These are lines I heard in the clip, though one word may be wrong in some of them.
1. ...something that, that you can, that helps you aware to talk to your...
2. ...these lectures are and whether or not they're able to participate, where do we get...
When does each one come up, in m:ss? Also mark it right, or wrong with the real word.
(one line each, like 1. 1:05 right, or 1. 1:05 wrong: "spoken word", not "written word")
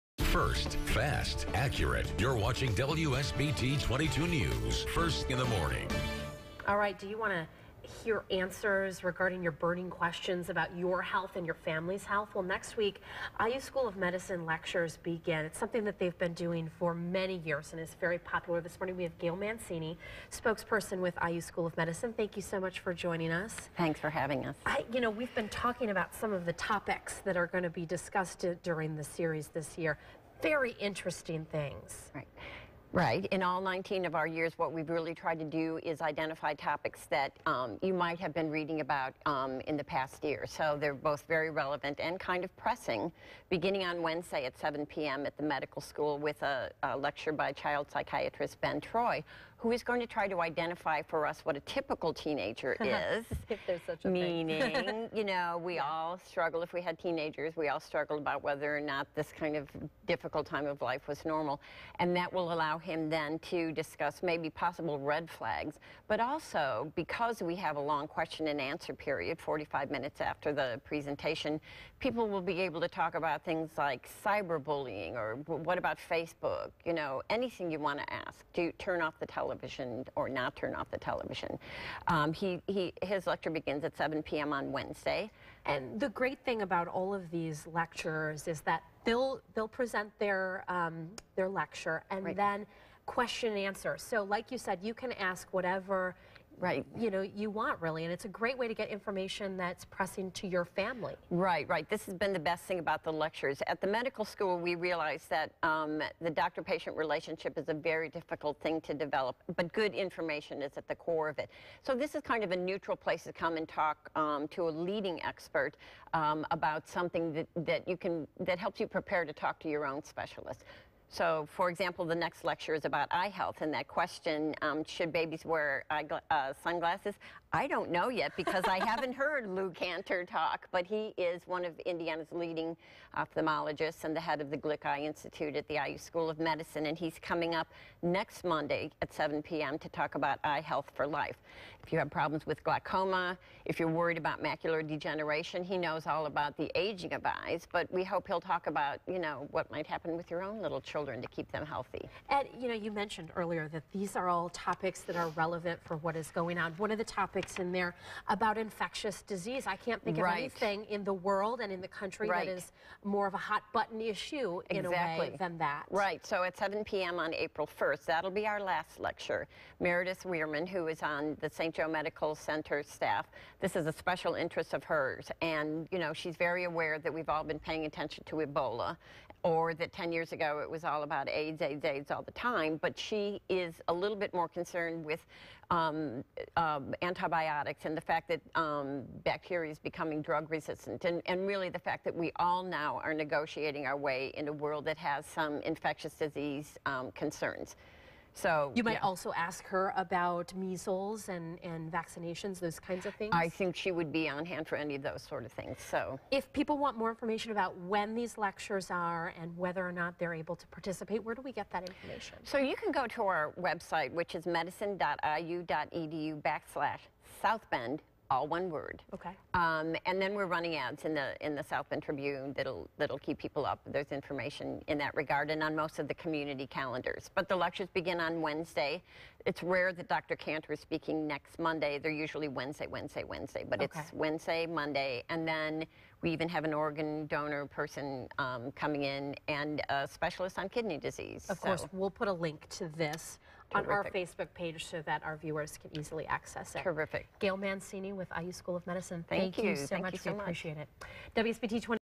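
1. 1:56 wrong: "prepare", not "aware"
2. 3:28 right.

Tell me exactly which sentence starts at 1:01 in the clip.
And that will allow him then to discuss maybe possible red flags.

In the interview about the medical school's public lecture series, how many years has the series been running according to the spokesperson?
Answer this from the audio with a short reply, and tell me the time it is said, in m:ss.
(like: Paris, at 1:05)
19, at 0:33.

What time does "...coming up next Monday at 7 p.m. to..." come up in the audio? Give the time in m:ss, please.
2:17.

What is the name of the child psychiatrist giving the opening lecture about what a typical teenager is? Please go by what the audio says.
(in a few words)
Ben Troy.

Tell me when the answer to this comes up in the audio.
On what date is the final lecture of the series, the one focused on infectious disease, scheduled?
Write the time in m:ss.
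2:47.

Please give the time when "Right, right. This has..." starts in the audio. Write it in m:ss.
1:41.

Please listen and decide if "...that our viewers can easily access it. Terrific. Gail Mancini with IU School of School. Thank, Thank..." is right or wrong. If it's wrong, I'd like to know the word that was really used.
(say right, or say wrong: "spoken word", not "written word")
wrong: "Medicine", not "School".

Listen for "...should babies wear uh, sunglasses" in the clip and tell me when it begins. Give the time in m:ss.
2:04.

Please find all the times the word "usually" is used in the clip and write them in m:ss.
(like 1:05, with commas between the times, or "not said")
3:52.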